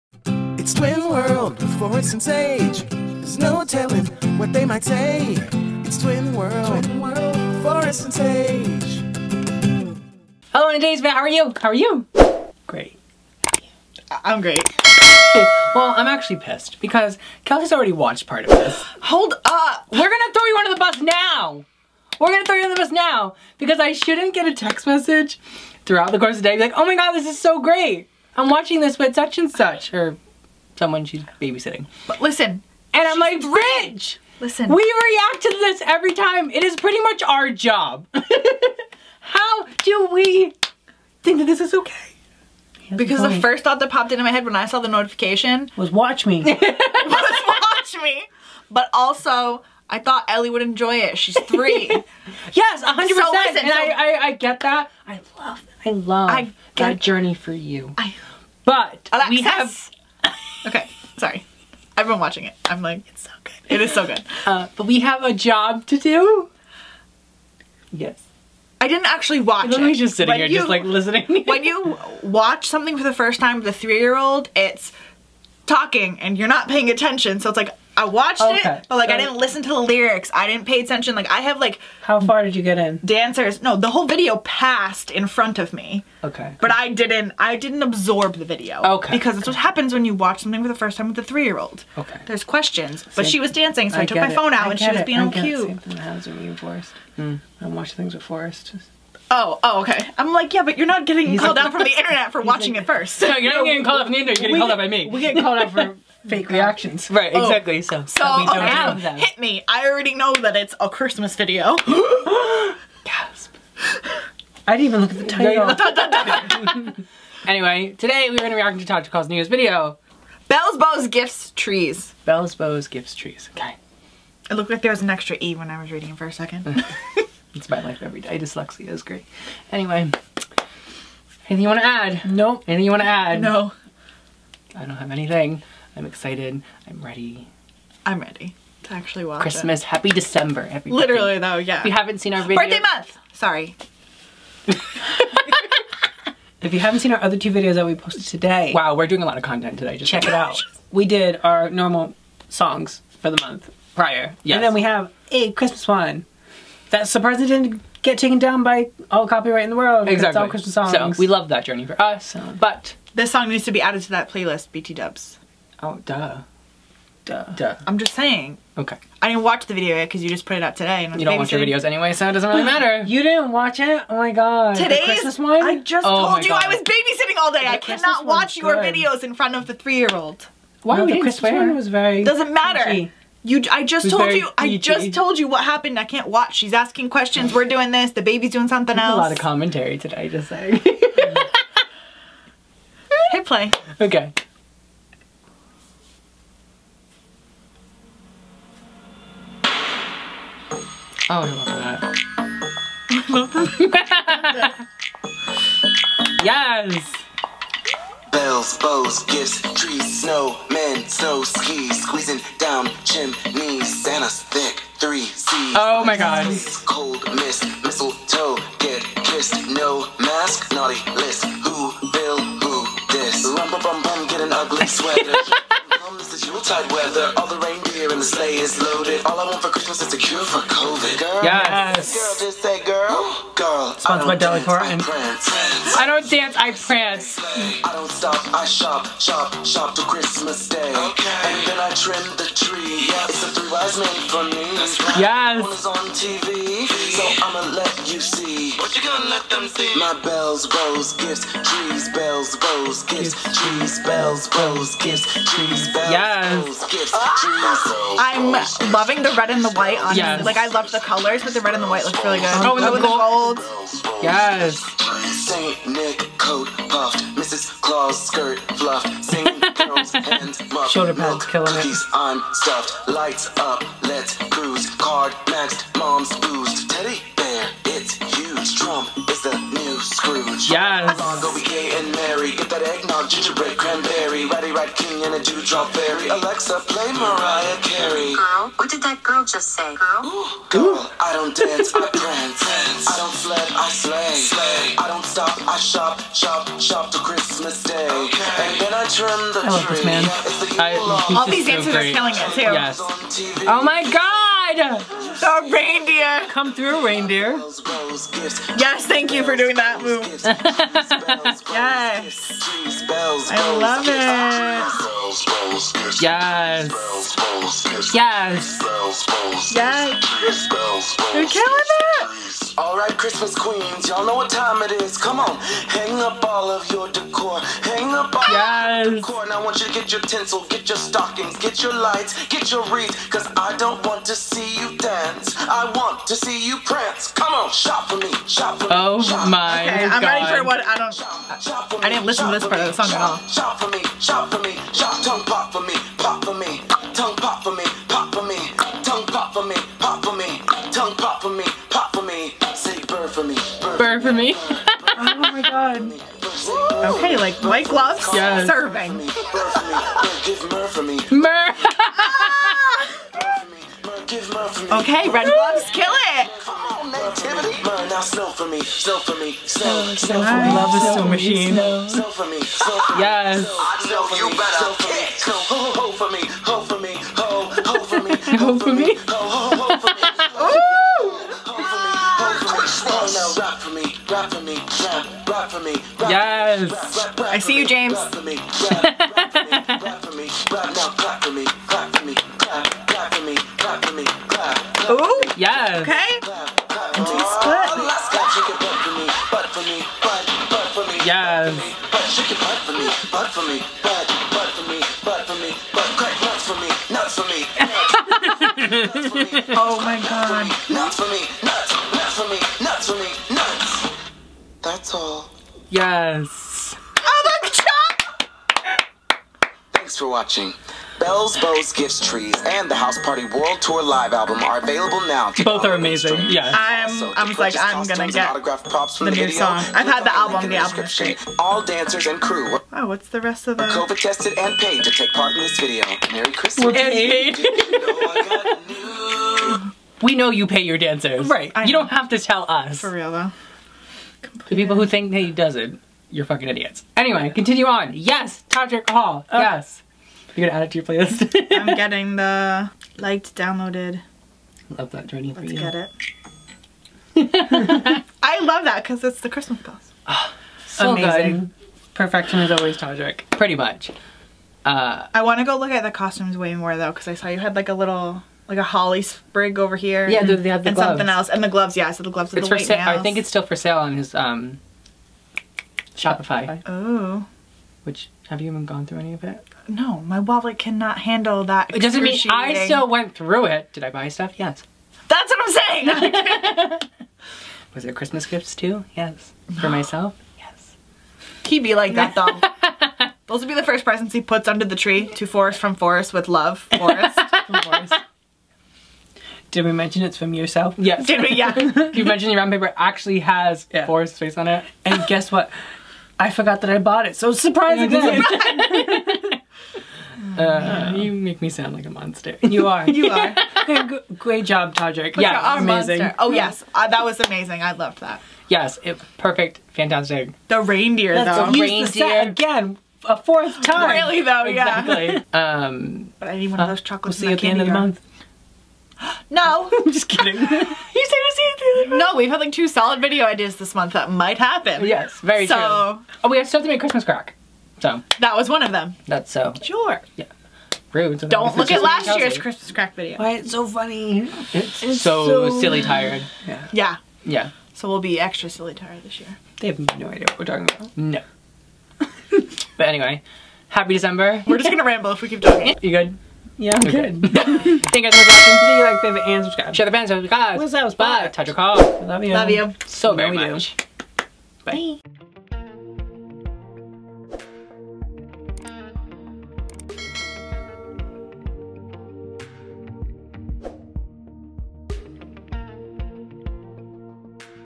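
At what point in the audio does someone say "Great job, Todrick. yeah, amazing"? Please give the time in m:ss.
8:34.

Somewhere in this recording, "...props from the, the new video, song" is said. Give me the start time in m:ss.
7:08.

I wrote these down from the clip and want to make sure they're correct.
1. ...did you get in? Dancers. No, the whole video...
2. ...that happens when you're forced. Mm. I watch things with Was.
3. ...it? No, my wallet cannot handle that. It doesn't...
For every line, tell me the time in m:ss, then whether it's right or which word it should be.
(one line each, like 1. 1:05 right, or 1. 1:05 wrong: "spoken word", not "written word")
1. 1:22 right
2. 1:35 wrong: "Forest", not "Was"
3. 7:59 right.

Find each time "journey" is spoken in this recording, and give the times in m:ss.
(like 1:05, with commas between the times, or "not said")
0:56, 2:41, 7:35.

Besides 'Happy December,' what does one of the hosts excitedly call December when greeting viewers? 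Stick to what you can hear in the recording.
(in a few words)
Birthday month.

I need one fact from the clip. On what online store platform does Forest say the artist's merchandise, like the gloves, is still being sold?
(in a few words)
Shopify.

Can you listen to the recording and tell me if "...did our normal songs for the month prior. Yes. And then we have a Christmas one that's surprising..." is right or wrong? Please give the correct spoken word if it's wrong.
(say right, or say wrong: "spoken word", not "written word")
right.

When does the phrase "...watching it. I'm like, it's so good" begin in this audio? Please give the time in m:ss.
1:02.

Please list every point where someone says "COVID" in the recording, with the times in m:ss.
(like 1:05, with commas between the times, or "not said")
3:50, 7:13.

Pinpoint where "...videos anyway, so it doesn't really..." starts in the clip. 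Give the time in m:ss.
2:51.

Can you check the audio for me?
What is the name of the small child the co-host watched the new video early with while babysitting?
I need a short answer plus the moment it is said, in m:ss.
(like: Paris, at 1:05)
Ellie, at 0:50.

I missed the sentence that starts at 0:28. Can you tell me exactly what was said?
I'm watching this with such and such, or someone she's babysitting.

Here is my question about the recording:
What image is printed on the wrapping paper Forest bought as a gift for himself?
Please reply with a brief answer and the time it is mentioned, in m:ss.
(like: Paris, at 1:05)
Forest's face, at 8:24.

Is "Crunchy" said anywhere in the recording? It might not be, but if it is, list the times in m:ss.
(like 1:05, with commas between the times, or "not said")
3:02.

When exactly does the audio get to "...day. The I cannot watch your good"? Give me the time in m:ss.
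2:57.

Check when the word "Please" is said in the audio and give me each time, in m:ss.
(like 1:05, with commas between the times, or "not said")
9:18.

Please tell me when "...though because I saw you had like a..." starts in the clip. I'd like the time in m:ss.
7:46.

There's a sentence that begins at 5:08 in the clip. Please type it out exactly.
Yes, thank you for doing that move.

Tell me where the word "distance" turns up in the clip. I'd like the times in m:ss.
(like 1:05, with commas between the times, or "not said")
not said.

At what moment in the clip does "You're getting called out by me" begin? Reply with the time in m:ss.
1:44.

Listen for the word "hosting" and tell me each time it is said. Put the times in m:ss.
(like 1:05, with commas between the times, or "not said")
not said.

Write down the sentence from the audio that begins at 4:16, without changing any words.
gifts, trees, I'm loving the red and the white on yes.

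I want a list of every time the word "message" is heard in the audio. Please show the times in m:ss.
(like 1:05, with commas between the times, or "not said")
0:24.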